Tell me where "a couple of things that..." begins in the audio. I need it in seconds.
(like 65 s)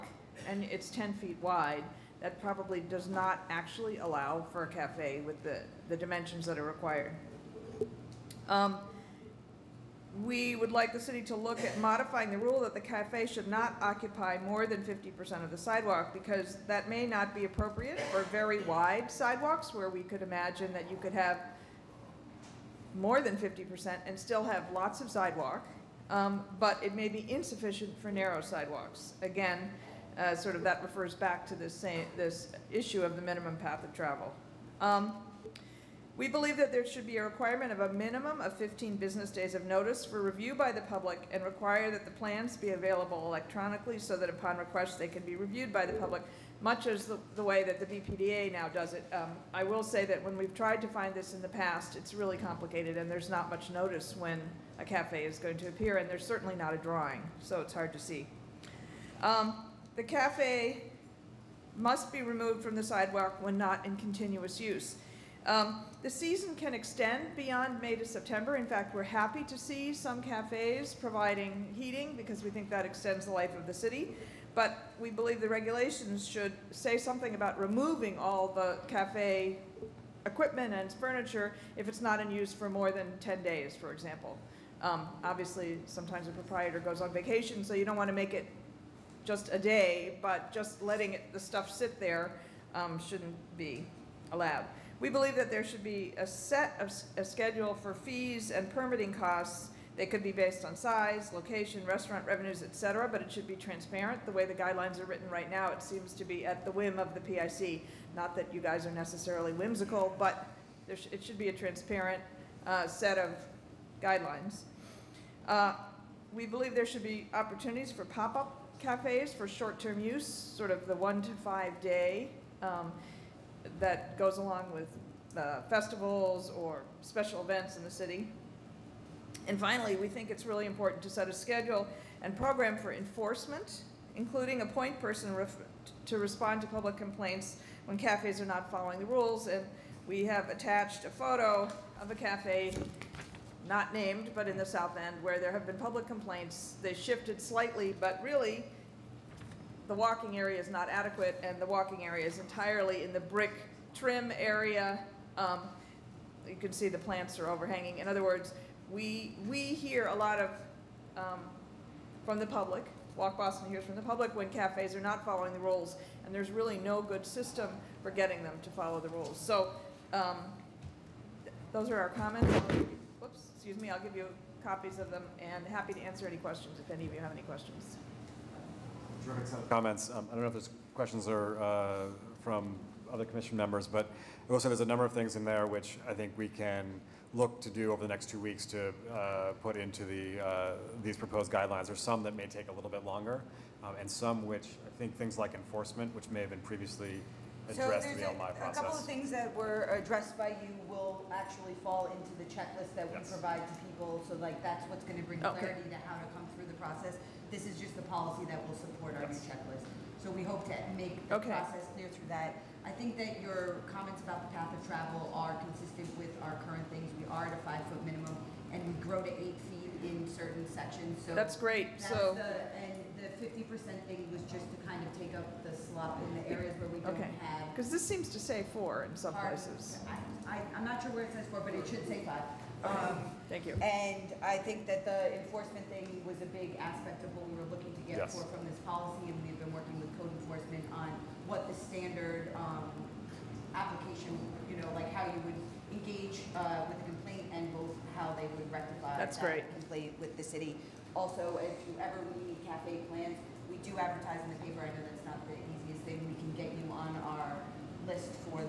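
198 s.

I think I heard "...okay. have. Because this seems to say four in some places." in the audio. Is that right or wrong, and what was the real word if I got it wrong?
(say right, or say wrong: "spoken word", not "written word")
right.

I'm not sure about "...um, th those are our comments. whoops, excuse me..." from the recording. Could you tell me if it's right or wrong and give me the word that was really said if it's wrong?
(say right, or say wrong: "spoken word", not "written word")
right.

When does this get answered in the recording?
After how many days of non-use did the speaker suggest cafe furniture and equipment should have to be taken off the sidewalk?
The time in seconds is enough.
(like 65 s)
83 s.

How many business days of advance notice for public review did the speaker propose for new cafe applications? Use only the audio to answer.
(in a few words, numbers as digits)
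15.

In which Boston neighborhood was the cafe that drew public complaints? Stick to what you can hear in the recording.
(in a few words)
South End.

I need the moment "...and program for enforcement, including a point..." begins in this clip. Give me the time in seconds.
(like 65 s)
132 s.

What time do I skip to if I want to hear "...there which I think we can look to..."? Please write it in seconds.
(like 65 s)
185 s.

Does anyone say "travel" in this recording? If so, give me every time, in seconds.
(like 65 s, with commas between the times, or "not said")
33 s, 214 s.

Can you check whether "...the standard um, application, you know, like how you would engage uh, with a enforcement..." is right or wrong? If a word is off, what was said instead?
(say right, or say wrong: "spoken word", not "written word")
wrong: "complaint", not "enforcement".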